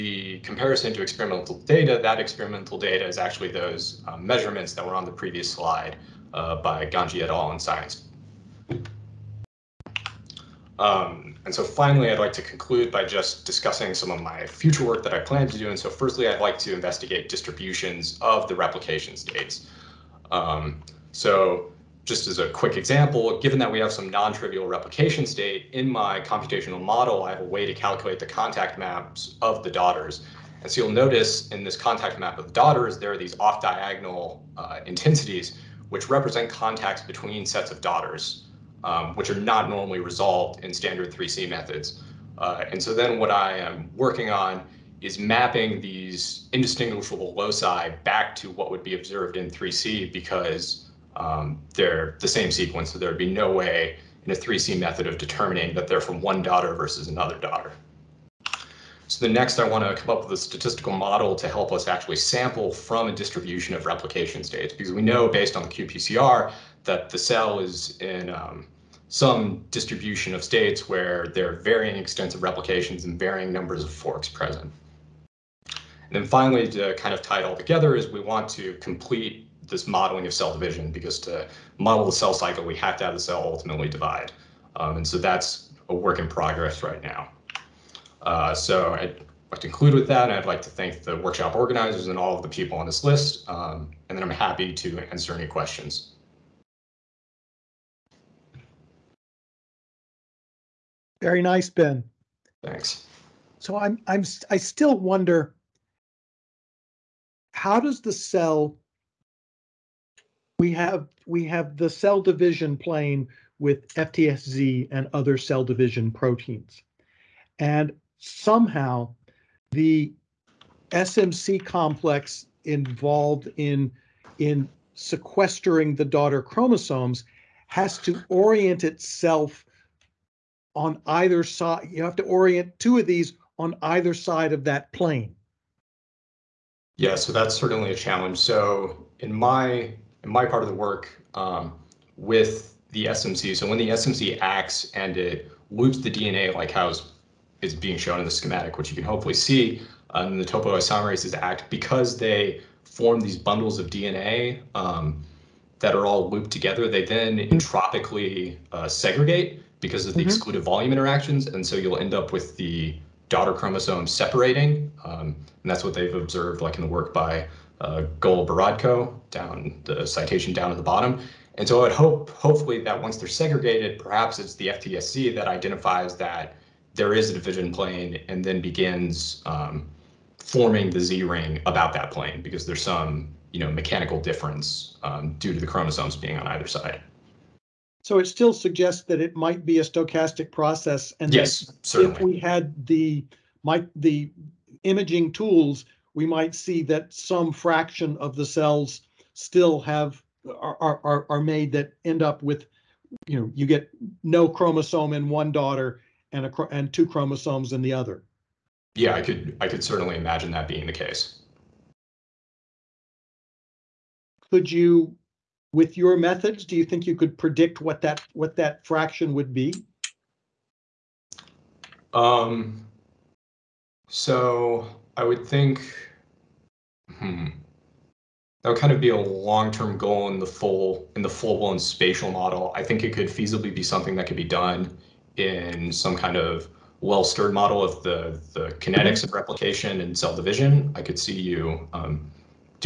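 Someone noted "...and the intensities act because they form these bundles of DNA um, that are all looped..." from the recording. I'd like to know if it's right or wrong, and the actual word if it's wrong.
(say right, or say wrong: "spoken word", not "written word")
wrong: "topoisomerases", not "intensities".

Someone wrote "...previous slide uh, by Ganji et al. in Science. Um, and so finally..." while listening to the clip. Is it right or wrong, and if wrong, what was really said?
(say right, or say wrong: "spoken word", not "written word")
right.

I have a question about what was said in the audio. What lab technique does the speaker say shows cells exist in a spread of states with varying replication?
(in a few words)
qPCR.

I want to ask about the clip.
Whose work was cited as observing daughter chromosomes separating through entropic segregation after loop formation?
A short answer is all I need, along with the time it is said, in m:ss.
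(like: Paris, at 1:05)
Goloborodko, at 2:48.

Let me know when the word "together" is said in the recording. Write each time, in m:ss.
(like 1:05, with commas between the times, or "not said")
1:17, 2:36.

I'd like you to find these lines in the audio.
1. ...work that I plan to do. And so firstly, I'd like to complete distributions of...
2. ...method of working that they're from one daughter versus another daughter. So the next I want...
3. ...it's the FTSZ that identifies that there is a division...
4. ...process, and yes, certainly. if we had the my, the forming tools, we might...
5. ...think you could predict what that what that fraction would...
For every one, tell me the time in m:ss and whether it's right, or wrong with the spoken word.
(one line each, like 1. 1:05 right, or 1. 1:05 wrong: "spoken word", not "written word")
1. 0:14 wrong: "investigate", not "complete"
2. 0:54 wrong: "determining", not "working"
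3. 2:54 right
4. 3:10 wrong: "imaging", not "forming"
5. 3:36 right.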